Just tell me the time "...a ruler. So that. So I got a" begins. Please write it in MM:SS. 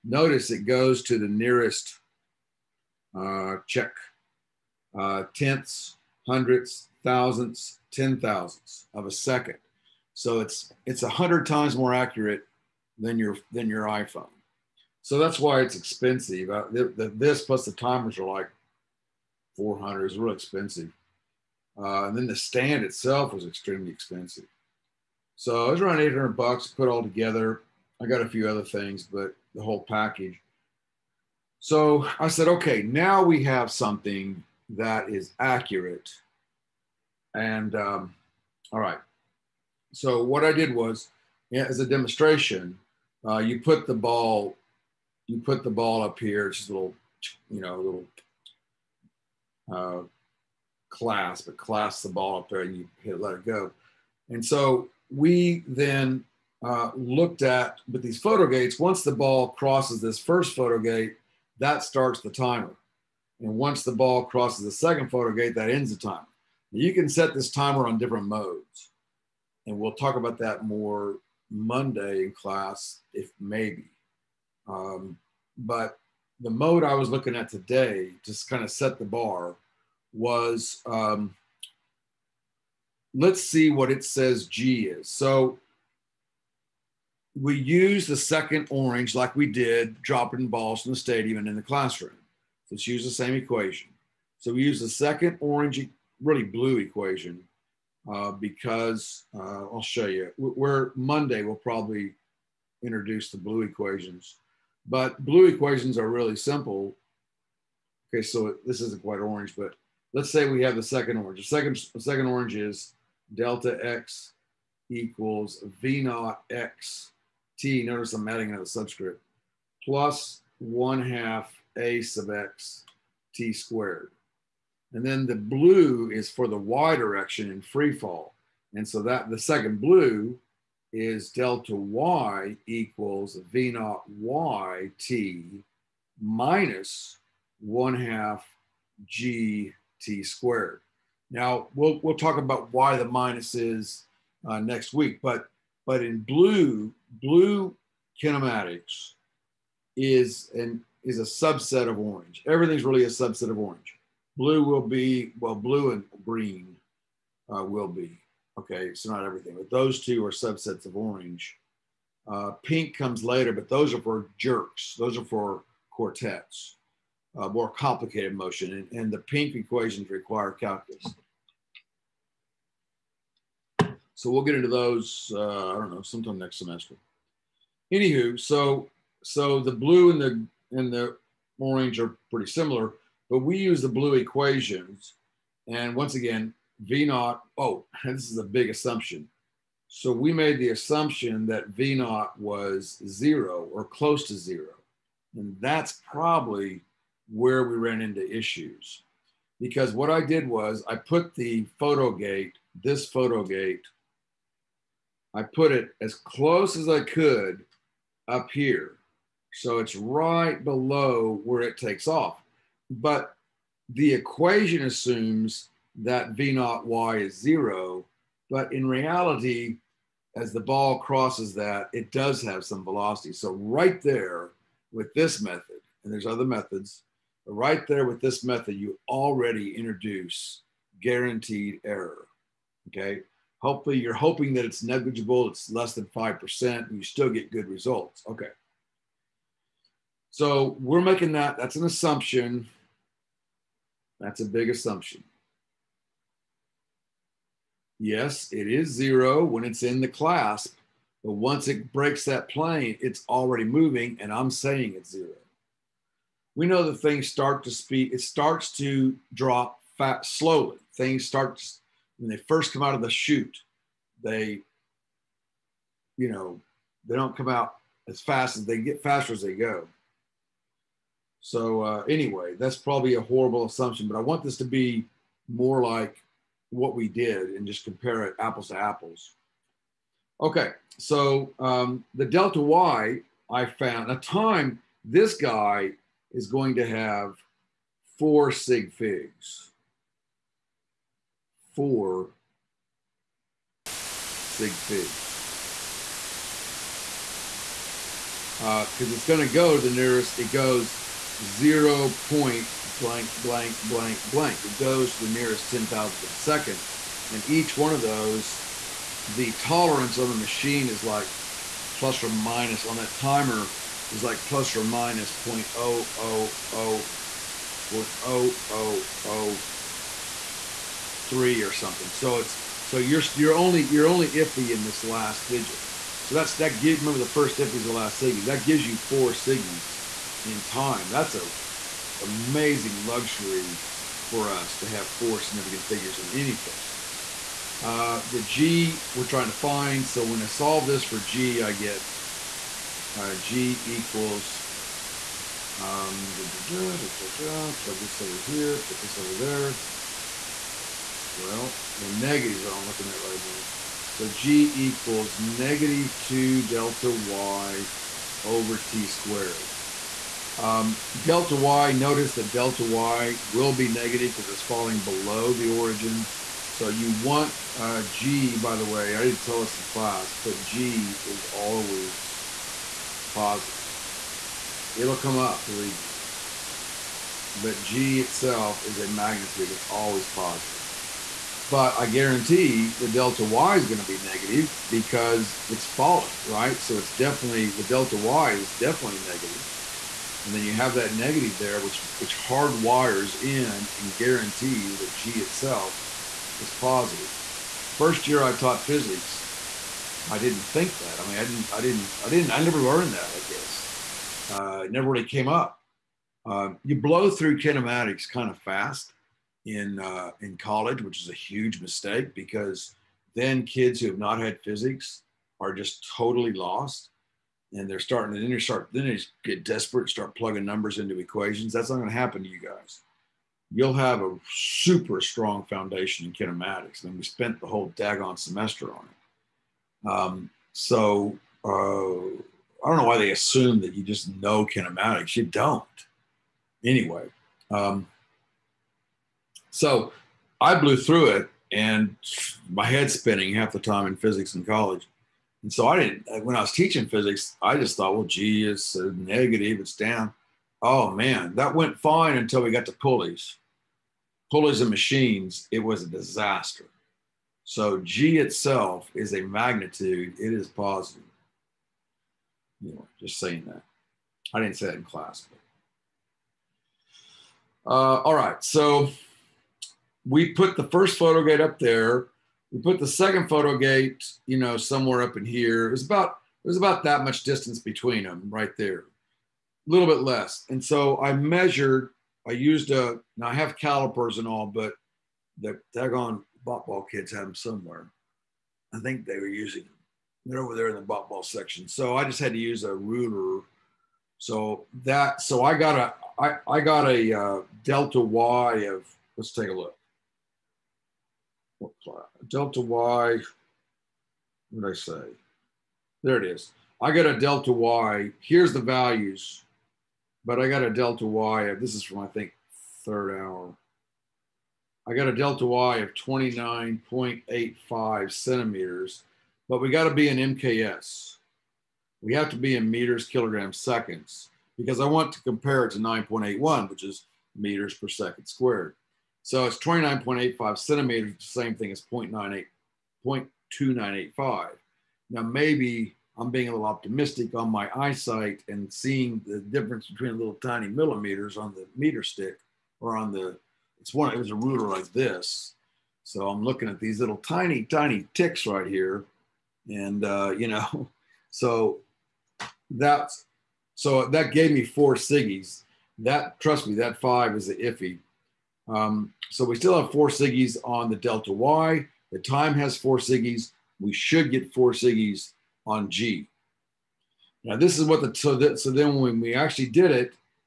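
08:12.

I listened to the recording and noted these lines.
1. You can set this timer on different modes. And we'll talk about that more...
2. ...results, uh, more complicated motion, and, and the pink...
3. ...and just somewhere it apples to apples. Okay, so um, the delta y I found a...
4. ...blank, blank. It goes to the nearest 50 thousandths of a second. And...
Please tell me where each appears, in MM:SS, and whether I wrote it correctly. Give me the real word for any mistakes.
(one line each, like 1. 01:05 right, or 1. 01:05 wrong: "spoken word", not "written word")
1. 01:06 right
2. 02:45 wrong: "quartets", not "results"
3. 04:37 wrong: "compare", not "somewhere"
4. 05:03 wrong: "10", not "50".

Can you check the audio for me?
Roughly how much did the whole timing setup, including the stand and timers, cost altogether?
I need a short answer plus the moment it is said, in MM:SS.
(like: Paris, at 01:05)
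$800, at 00:26.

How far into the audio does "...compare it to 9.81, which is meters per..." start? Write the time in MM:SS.
08:45.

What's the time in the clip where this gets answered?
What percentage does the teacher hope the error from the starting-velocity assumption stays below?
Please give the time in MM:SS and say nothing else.
03:56.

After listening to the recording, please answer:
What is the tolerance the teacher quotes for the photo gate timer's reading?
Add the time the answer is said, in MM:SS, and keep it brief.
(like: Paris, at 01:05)
plus or minus 0.0003, at 05:14.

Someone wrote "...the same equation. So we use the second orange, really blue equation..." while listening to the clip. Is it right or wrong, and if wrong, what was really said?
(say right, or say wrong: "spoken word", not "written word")
right.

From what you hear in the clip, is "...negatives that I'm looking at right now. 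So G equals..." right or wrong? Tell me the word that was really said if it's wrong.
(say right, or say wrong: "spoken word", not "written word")
right.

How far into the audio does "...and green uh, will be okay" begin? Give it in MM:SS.
02:35.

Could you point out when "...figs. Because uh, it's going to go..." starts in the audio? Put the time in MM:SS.
04:54.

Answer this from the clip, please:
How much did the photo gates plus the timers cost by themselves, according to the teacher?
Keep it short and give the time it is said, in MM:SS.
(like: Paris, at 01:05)
400, at 00:19.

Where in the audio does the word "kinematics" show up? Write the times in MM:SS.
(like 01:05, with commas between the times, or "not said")
02:28, 06:47, 07:06, 07:14.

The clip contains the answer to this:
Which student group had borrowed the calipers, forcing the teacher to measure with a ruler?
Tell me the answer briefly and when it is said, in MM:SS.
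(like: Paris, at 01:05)
Botball kids, at 08:06.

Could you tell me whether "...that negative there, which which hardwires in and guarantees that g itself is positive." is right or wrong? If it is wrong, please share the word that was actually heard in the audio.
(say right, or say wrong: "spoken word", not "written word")
right.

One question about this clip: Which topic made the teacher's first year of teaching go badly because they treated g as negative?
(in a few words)
Pulleys and machines.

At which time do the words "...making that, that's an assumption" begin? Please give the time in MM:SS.
04:00.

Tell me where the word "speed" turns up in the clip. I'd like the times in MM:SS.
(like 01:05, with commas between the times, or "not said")
04:17.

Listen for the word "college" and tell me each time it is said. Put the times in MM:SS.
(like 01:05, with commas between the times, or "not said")
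06:50, 07:24.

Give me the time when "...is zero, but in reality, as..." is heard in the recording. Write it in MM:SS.
03:37.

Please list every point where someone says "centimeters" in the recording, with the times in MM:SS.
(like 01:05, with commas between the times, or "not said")
08:38, 08:50.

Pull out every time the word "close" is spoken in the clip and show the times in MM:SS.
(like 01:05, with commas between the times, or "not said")
03:13, 03:26.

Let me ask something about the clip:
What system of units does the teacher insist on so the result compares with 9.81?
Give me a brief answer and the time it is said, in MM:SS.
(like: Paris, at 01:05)
MKS, at 08:40.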